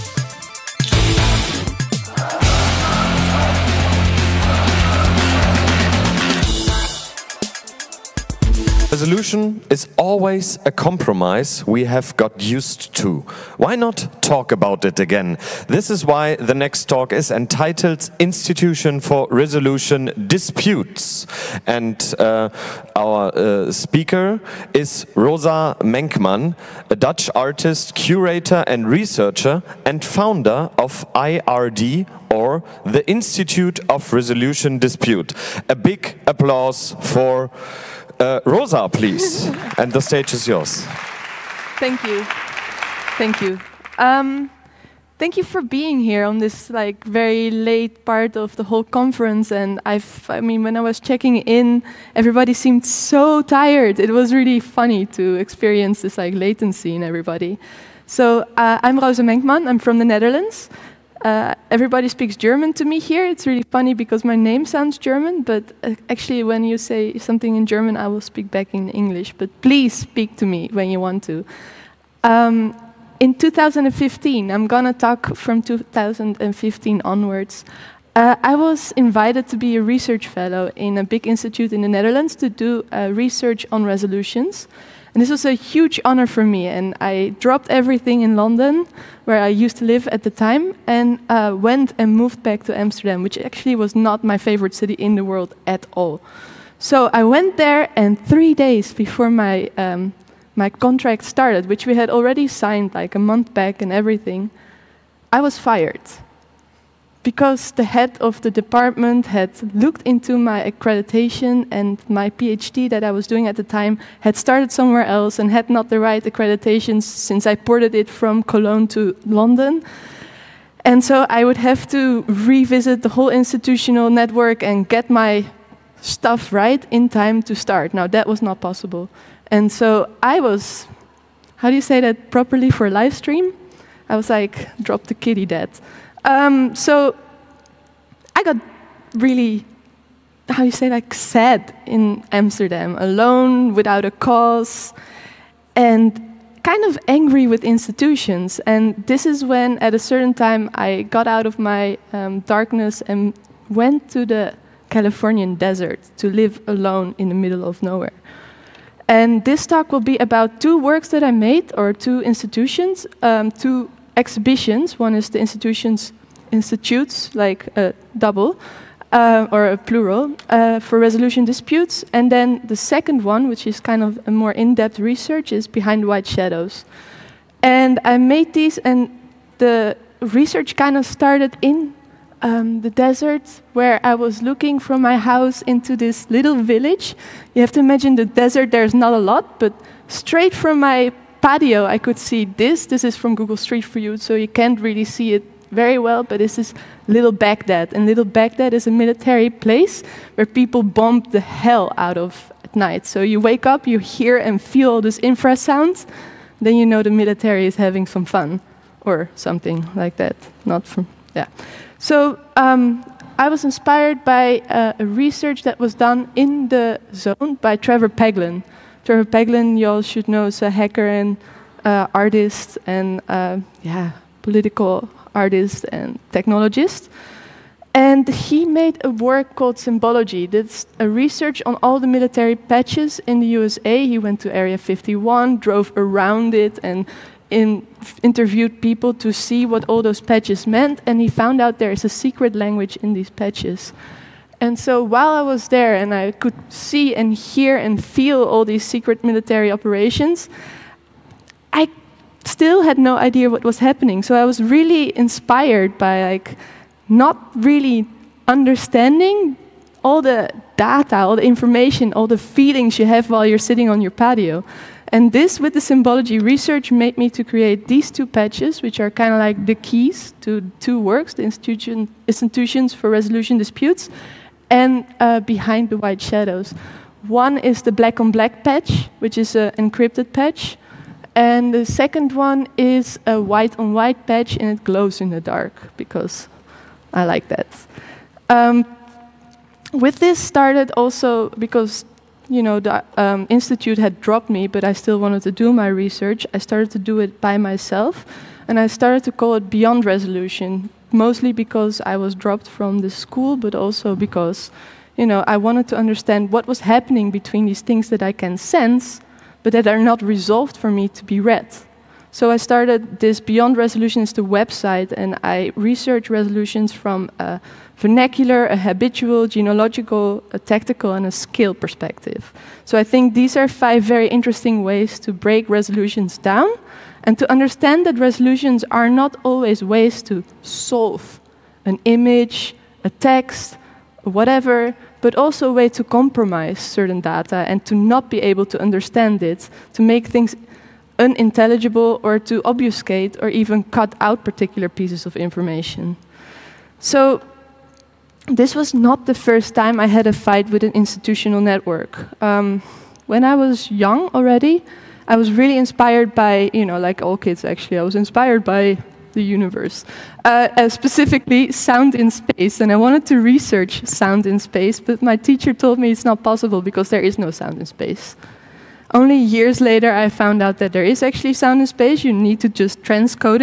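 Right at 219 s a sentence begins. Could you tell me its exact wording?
Trevor Paglen, you all should know, is a hacker and uh, artist and uh, yeah, political artist and technologist.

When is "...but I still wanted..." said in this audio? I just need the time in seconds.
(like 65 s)
294 s.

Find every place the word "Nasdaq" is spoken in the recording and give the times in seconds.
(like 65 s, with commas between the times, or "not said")
not said.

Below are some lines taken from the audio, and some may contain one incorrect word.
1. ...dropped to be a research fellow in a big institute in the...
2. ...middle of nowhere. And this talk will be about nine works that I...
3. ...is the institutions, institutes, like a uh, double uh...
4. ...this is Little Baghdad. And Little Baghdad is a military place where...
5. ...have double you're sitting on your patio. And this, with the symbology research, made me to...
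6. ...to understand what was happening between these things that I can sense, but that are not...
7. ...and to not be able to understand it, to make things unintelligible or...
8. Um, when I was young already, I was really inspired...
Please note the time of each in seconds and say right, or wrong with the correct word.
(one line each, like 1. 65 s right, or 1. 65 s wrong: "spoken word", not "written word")
1. 78 s wrong: "invited", not "dropped"
2. 157 s wrong: "two", not "nine"
3. 165 s right
4. 196 s right
5. 263 s wrong: "while", not "double"
6. 305 s right
7. 337 s right
8. 352 s right.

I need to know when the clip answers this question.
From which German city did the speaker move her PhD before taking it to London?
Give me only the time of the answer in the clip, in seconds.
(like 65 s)
118 s.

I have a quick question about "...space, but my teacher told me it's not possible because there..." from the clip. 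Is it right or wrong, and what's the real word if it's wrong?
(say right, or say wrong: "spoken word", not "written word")
right.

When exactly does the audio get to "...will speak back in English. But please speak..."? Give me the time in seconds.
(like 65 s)
68 s.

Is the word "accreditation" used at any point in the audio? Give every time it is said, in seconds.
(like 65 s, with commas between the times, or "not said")
110 s, 116 s.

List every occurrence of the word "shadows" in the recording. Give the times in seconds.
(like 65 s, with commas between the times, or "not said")
176 s, 276 s.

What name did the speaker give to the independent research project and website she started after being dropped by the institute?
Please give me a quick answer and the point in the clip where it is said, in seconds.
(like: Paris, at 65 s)
Beyond Resolution, at 299 s.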